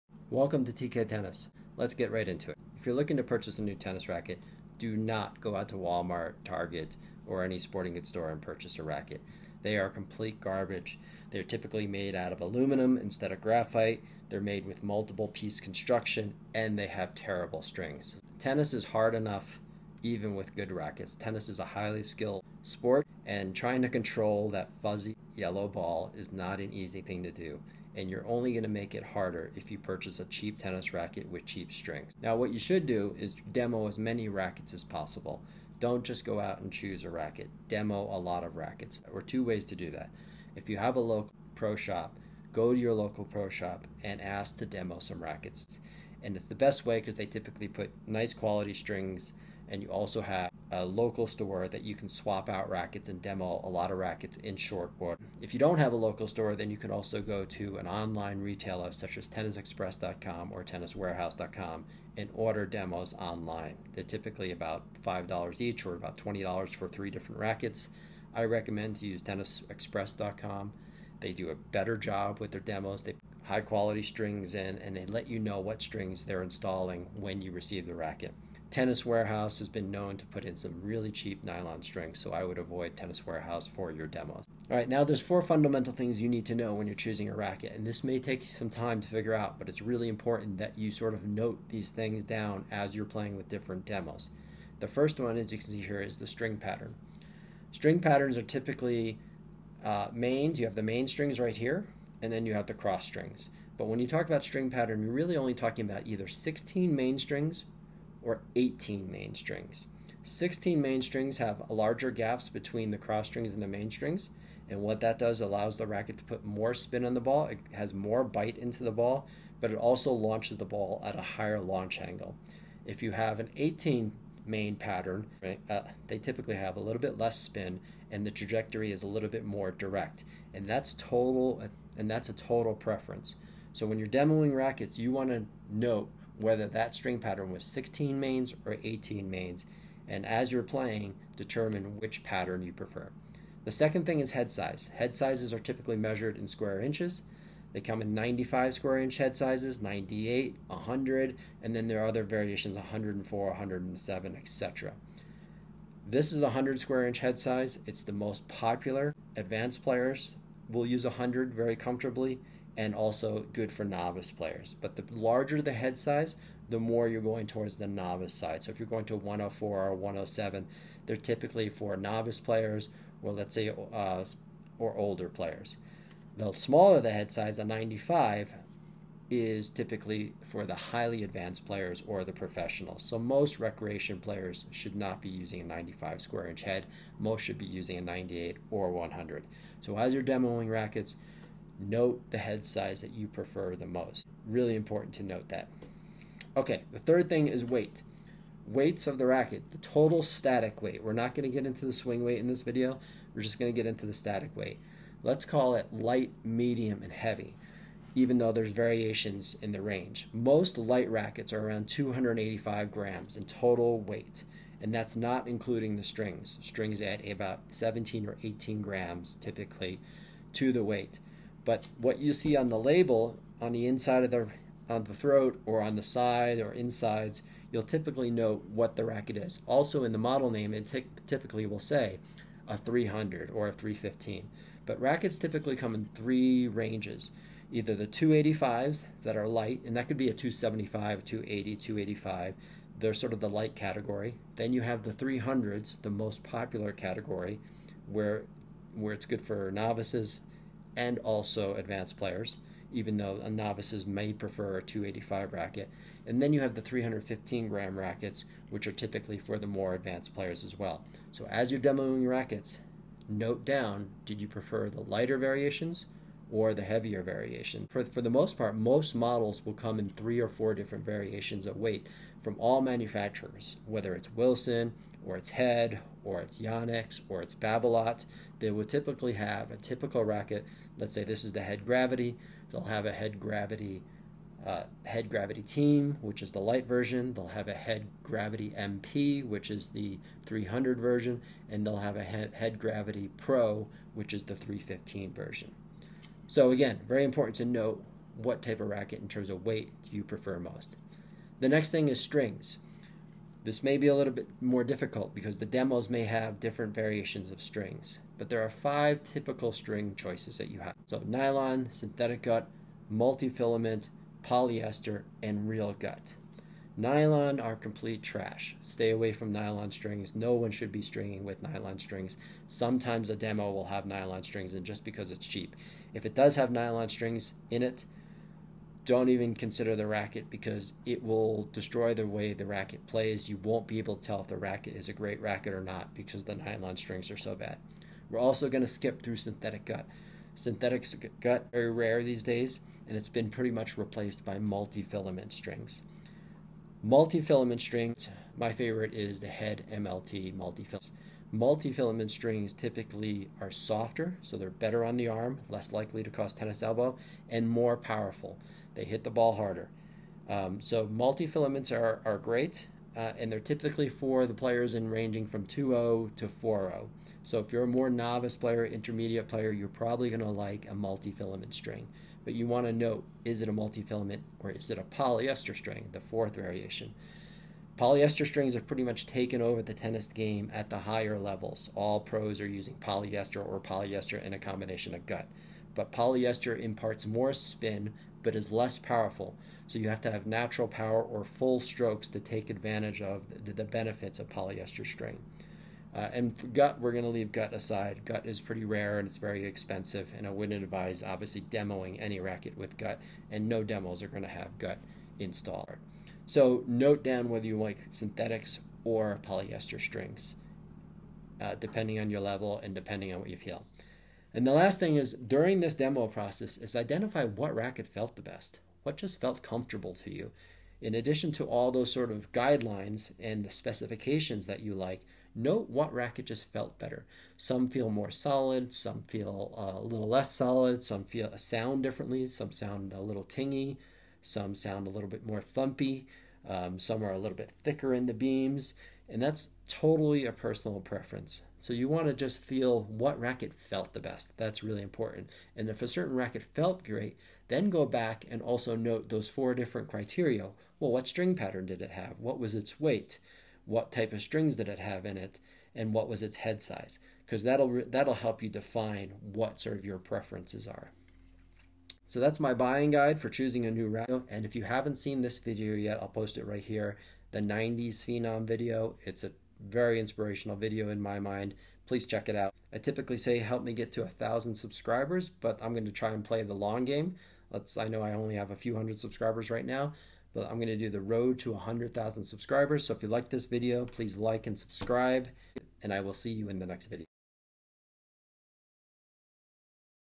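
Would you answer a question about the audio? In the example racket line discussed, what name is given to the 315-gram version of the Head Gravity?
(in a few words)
Head Gravity Pro.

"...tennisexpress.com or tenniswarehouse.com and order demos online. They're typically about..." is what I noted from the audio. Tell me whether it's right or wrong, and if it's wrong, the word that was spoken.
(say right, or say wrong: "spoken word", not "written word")
right.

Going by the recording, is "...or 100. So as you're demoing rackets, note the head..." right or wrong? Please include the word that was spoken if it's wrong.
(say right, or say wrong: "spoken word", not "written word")
right.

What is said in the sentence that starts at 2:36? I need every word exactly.
This is a 100 square inch head size.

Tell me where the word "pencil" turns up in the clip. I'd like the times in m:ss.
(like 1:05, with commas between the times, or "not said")
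not said.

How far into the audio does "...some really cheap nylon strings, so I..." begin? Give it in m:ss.
1:20.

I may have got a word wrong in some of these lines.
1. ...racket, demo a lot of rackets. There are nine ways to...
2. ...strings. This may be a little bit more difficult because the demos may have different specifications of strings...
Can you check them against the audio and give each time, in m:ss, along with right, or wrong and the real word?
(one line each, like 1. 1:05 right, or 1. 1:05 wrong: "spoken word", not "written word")
1. 0:37 wrong: "two", not "nine"
2. 5:02 wrong: "variations", not "specifications".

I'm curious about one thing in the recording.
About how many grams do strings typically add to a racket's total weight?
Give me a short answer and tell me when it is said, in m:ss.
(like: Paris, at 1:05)
17 or 18 grams, at 3:37.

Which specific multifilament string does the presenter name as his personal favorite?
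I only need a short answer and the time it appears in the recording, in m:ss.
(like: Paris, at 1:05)
Head MLT, at 5:49.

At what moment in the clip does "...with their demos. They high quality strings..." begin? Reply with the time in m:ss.
1:12.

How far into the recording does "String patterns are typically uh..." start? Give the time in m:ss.
1:37.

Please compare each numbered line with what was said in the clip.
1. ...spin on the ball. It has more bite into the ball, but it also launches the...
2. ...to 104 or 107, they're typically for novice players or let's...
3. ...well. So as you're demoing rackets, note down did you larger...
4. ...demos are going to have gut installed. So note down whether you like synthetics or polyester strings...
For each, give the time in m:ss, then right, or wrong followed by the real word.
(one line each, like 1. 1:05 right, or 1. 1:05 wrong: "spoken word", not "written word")
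1. 1:56 right
2. 2:49 right
3. 4:20 wrong: "prefer", not "larger"
4. 6:43 right.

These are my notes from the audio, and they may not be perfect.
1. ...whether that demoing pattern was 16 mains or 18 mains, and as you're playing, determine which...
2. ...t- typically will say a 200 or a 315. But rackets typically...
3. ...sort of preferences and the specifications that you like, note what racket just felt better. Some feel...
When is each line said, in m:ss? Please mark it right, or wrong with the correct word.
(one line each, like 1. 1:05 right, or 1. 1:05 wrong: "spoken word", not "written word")
1. 2:16 wrong: "string", not "demoing"
2. 3:50 wrong: "300", not "200"
3. 7:02 wrong: "guidelines", not "preferences".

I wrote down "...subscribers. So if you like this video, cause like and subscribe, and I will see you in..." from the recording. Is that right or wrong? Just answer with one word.
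wrong.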